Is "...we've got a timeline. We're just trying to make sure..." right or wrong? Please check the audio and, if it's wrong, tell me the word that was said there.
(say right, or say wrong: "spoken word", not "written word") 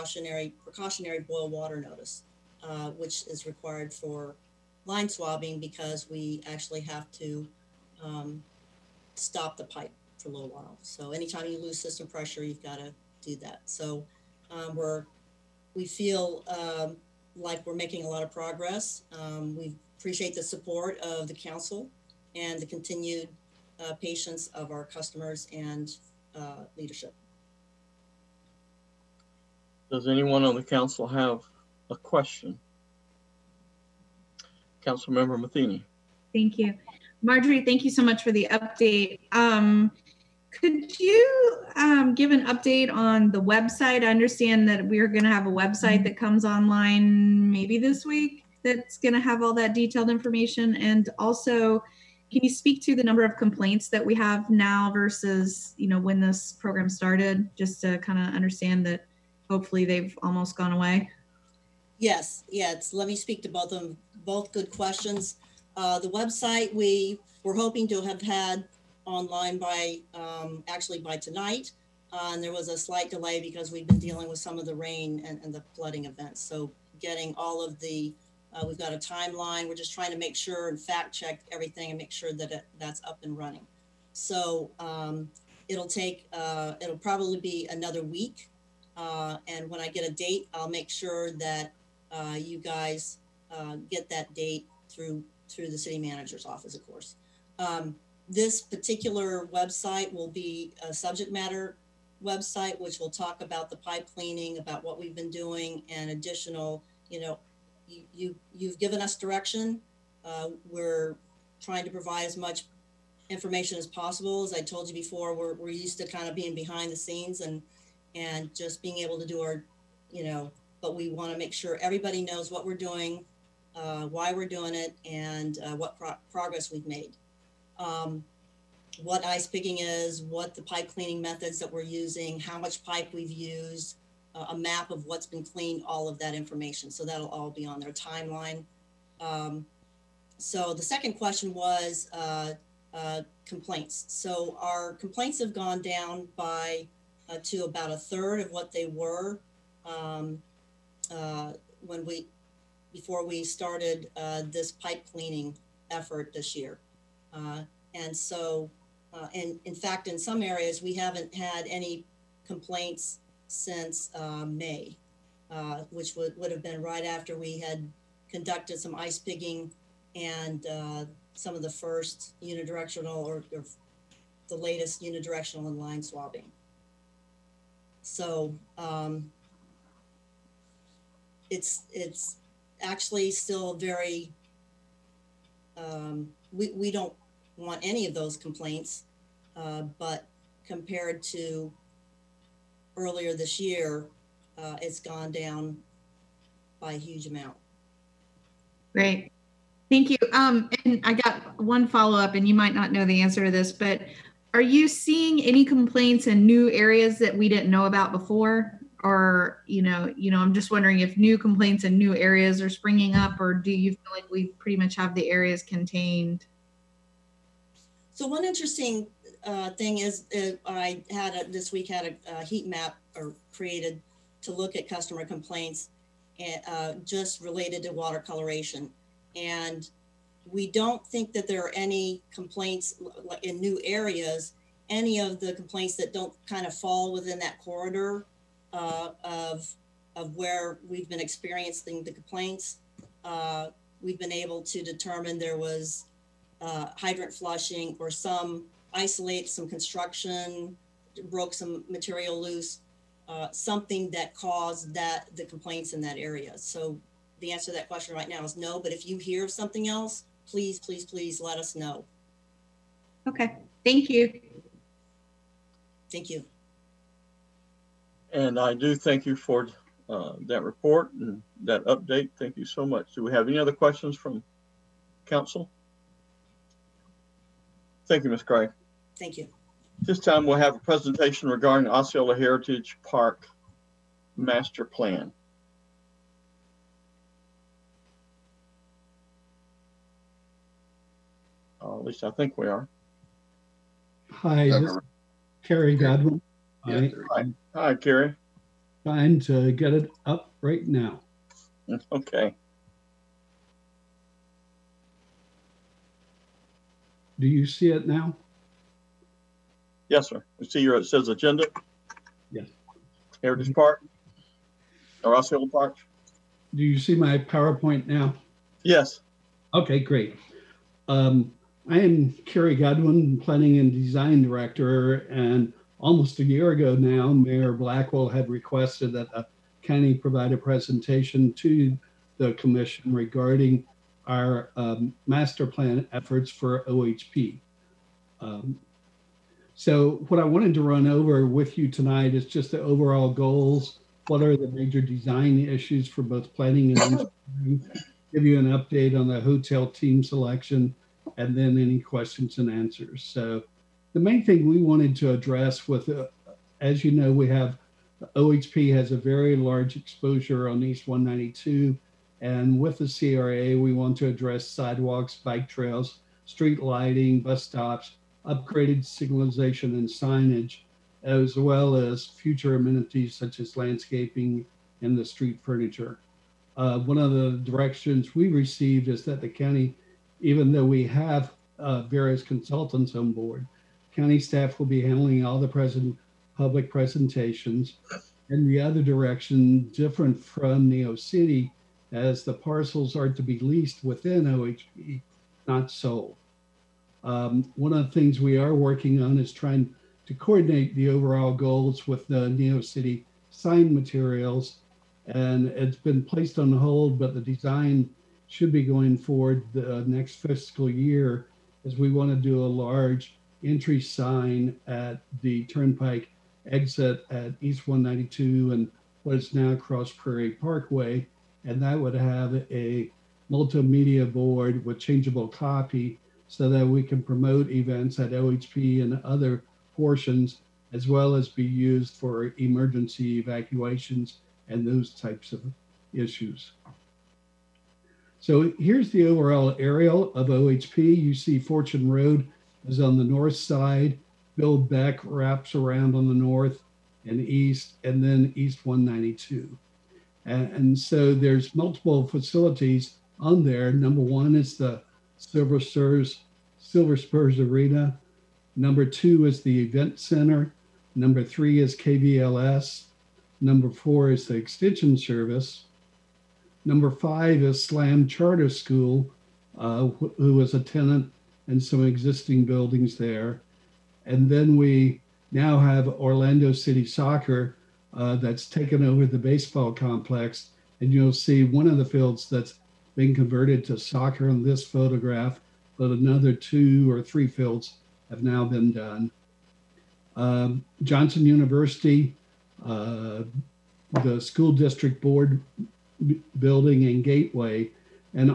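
right.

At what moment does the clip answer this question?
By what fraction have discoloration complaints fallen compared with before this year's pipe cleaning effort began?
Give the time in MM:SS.
02:27.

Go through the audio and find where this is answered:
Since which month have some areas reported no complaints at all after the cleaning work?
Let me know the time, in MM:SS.
02:44.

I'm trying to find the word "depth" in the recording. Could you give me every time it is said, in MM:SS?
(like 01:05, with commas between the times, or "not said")
not said.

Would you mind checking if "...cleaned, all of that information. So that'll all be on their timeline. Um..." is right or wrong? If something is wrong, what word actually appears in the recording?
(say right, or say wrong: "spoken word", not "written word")
right.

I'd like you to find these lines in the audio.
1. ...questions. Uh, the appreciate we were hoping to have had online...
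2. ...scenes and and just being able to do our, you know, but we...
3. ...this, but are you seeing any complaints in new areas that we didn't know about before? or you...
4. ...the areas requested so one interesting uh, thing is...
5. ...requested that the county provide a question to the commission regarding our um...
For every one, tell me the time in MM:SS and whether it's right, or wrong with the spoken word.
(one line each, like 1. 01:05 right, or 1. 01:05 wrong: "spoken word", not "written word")
1. 01:04 wrong: "website", not "appreciate"
2. 01:56 right
3. 03:23 right
4. 03:35 wrong: "contained", not "requested"
5. 05:28 wrong: "presentation", not "question".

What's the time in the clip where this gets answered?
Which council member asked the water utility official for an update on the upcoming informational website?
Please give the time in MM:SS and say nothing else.
00:34.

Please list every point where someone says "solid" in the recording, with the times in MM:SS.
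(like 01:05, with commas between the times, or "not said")
not said.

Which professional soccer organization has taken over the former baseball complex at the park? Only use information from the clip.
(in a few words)
Orlando City Soccer.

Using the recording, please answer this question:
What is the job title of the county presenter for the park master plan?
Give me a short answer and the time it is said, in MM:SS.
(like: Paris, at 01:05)
Planning and Design Director, at 05:23.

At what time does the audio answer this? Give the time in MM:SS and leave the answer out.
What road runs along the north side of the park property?
07:21.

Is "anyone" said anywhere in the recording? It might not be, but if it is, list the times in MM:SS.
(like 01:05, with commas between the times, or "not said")
00:30.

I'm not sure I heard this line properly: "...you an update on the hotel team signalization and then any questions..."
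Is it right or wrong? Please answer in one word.
wrong.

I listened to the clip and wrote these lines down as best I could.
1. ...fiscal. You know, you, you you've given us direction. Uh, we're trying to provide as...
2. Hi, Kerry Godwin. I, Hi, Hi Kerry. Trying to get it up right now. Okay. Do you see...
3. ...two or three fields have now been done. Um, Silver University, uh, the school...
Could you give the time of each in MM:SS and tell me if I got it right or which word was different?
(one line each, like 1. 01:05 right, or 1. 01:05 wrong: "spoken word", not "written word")
1. 01:46 wrong: "additional", not "fiscal"
2. 04:54 right
3. 08:06 wrong: "Johnson", not "Silver".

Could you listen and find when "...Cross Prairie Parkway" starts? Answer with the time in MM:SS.
06:59.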